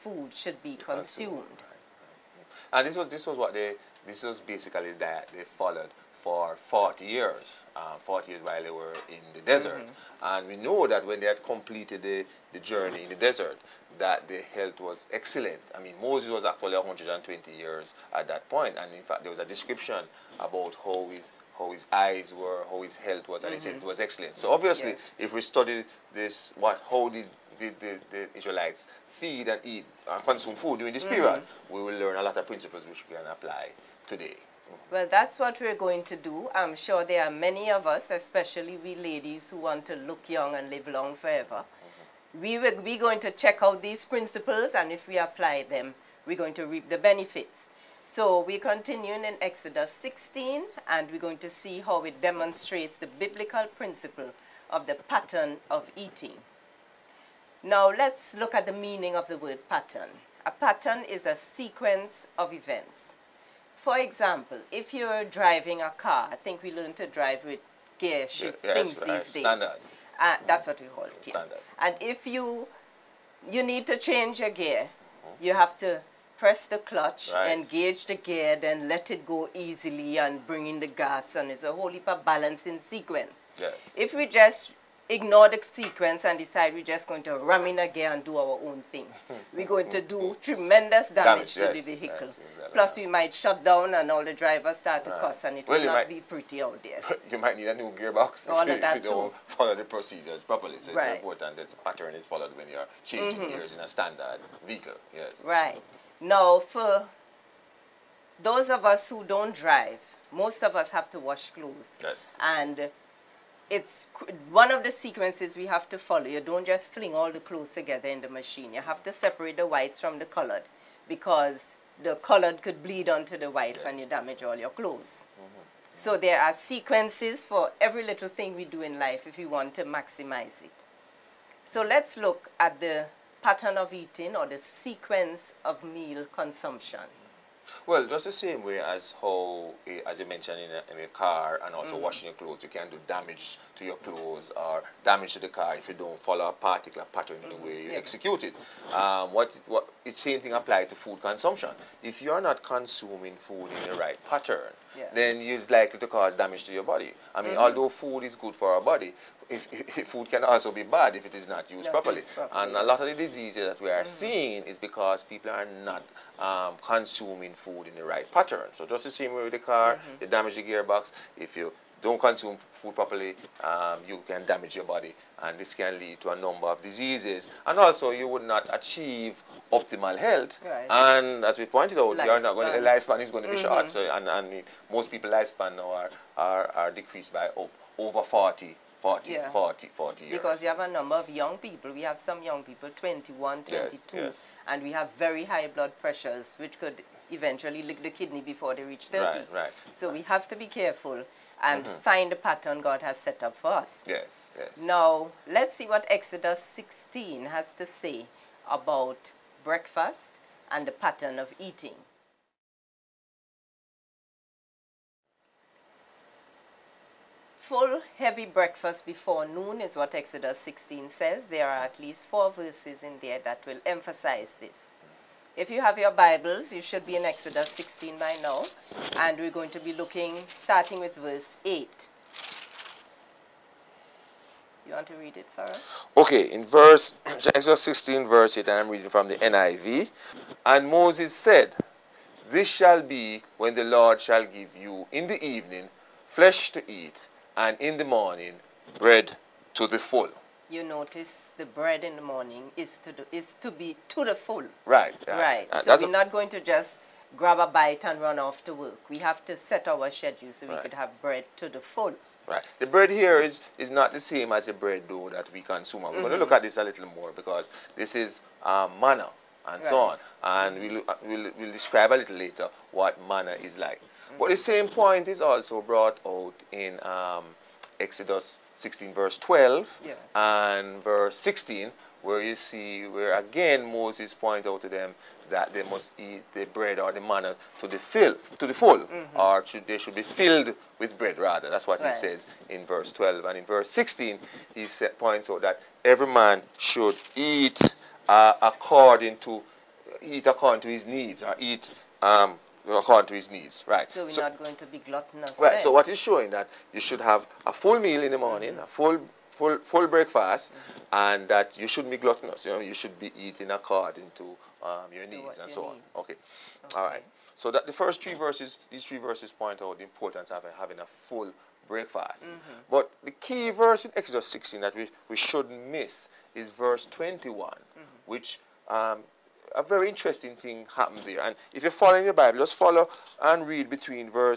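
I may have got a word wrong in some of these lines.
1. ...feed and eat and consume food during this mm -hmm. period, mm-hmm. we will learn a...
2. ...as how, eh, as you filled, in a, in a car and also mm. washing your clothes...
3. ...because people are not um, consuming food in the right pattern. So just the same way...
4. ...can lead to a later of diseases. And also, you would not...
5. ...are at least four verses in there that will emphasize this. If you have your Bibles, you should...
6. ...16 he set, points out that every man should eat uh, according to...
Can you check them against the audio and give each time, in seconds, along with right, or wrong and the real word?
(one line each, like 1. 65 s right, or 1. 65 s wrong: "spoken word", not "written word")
1. 29 s right
2. 138 s wrong: "mentioned", not "filled"
3. 164 s right
4. 175 s wrong: "number", not "later"
5. 221 s right
6. 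293 s right.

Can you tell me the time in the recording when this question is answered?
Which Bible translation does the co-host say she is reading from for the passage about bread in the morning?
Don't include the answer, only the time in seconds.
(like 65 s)
239 s.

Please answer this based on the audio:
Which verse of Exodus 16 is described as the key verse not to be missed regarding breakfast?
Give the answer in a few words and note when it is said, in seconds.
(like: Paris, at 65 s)
Verse 21, at 326 s.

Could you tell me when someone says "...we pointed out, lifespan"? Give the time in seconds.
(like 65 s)
181 s.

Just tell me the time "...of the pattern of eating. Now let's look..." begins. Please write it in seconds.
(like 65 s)
54 s.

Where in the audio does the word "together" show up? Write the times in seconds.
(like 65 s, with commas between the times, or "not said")
117 s.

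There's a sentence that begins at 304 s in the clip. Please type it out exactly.
So we're so, not going to be gluttonous.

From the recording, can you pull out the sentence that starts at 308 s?
a full full, full breakfast mm-hmm.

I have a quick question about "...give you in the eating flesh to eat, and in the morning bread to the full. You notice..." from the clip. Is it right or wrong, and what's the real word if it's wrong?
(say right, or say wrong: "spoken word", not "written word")
wrong: "evening", not "eating".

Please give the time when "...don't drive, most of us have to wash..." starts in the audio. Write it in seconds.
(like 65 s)
109 s.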